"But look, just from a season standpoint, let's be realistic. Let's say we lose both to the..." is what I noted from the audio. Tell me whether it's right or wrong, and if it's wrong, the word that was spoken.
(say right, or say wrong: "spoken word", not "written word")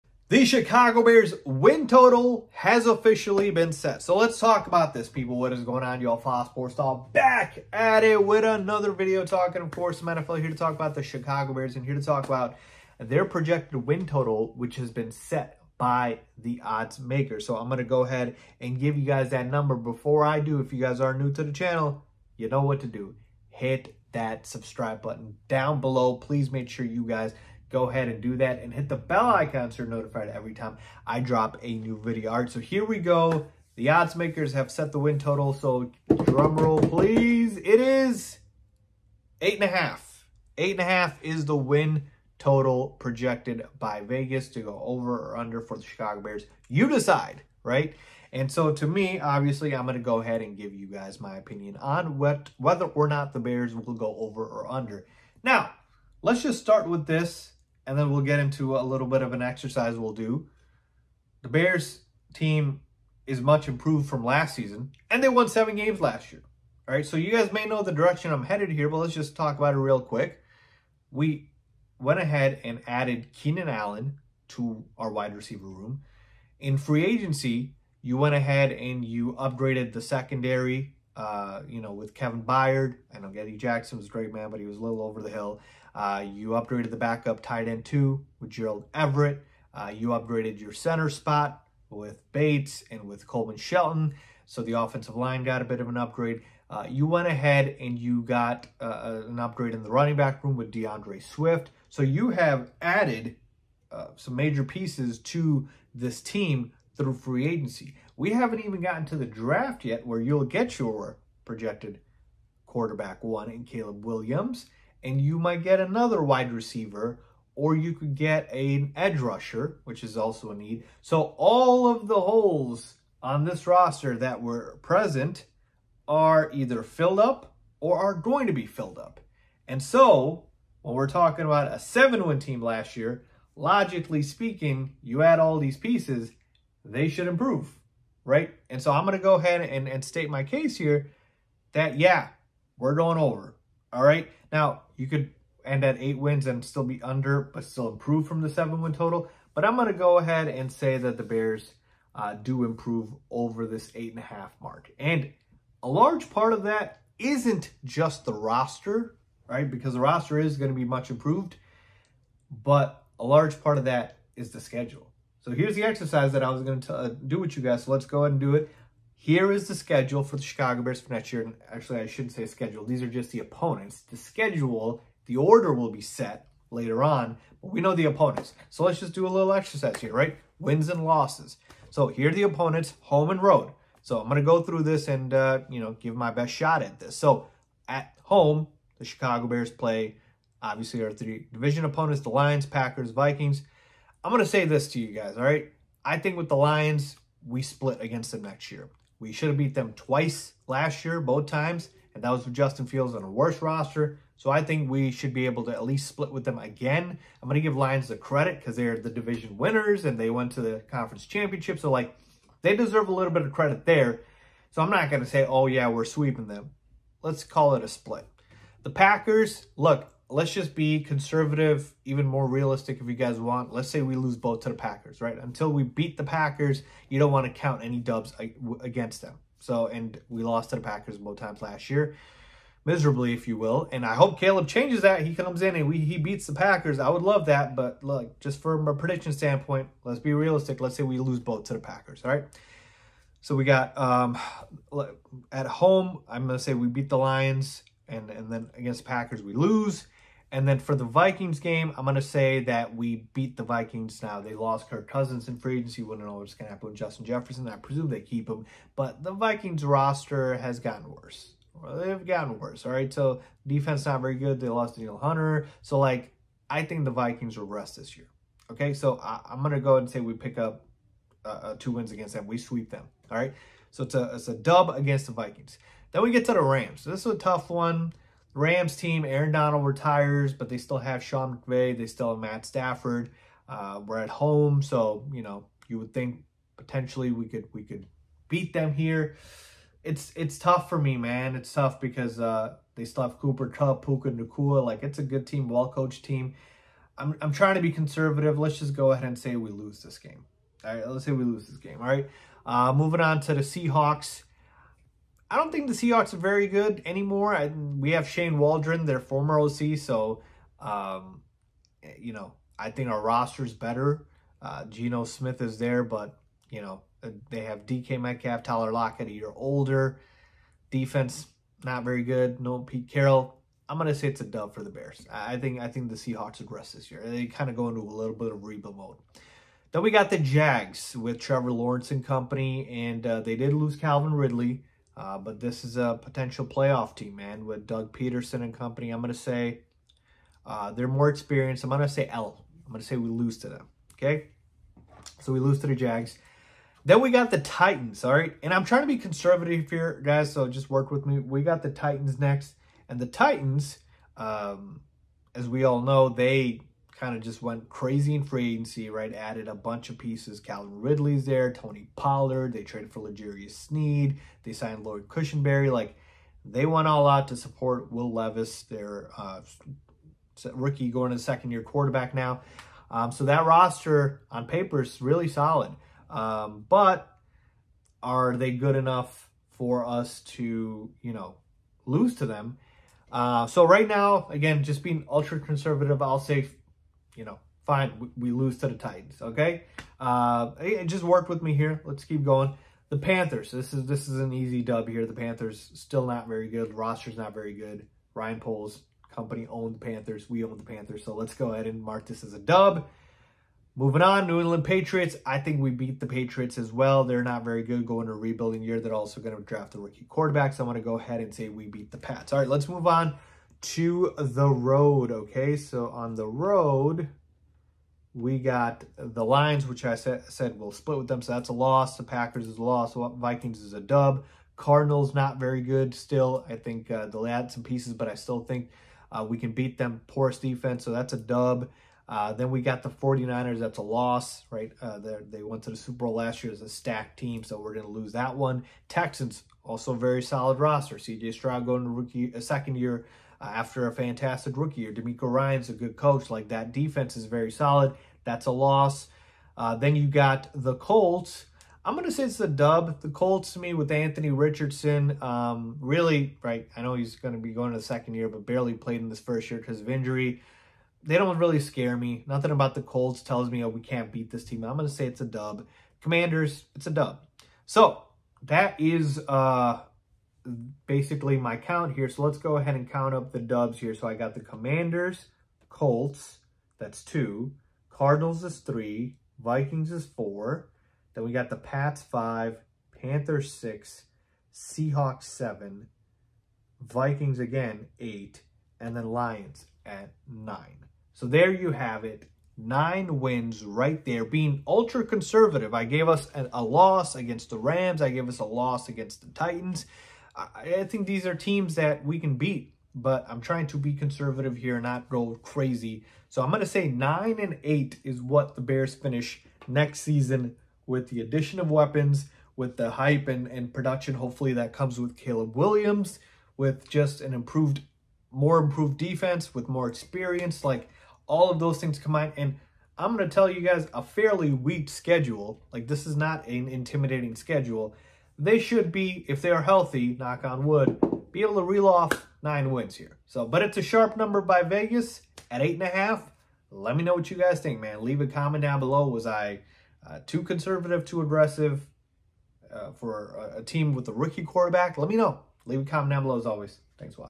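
wrong: "prediction", not "season".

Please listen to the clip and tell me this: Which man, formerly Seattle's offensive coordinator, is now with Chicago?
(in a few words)
Shane Waldron.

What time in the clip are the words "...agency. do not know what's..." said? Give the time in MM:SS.
04:15.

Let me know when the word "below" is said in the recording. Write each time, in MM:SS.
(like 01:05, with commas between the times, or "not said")
00:25, 08:58, 09:06.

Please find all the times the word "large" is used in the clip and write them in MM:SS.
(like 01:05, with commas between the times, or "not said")
02:35, 02:43.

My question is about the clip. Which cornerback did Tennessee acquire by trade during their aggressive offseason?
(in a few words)
L'Jarius Sneed.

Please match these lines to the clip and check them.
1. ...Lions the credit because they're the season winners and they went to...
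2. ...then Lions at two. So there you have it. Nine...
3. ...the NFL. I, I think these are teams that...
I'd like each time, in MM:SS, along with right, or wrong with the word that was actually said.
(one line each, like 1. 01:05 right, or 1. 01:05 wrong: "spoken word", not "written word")
1. 03:27 wrong: "division", not "season"
2. 08:09 wrong: "nine", not "two"
3. 08:19 wrong: "Titans", not "NFL".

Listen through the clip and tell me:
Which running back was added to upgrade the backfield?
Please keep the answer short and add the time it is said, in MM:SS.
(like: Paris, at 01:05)
D'Andre Swift, at 01:40.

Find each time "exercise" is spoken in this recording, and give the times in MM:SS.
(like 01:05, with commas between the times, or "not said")
00:59, 02:45, 02:59.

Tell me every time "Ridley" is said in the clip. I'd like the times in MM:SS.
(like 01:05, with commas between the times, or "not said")
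05:34, 06:01.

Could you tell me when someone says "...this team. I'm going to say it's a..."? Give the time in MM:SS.
07:44.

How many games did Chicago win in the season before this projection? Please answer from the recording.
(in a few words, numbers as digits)
7.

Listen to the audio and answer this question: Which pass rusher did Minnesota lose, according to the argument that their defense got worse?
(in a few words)
Danielle Hunter.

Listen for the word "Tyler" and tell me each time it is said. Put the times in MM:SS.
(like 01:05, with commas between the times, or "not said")
05:18.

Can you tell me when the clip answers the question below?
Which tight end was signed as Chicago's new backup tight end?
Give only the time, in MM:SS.
01:28.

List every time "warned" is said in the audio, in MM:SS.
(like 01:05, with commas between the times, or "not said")
not said.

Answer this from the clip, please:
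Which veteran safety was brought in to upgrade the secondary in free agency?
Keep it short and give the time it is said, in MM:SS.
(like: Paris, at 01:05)
Kevin Byard, at 01:22.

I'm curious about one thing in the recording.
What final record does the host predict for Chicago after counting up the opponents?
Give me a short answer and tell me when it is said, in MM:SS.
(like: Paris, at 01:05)
9 and 8, at 08:27.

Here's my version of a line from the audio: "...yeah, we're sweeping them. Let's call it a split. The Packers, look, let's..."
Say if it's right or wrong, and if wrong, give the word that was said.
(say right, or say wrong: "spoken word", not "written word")
right.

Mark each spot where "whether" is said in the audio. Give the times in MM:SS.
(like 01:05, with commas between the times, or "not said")
00:52.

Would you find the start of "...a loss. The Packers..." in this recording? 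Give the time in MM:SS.
07:01.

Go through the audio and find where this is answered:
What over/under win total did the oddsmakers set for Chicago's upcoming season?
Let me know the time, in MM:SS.
00:39.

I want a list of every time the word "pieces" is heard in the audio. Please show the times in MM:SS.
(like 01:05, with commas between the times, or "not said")
01:44, 02:15, 06:00, 07:07.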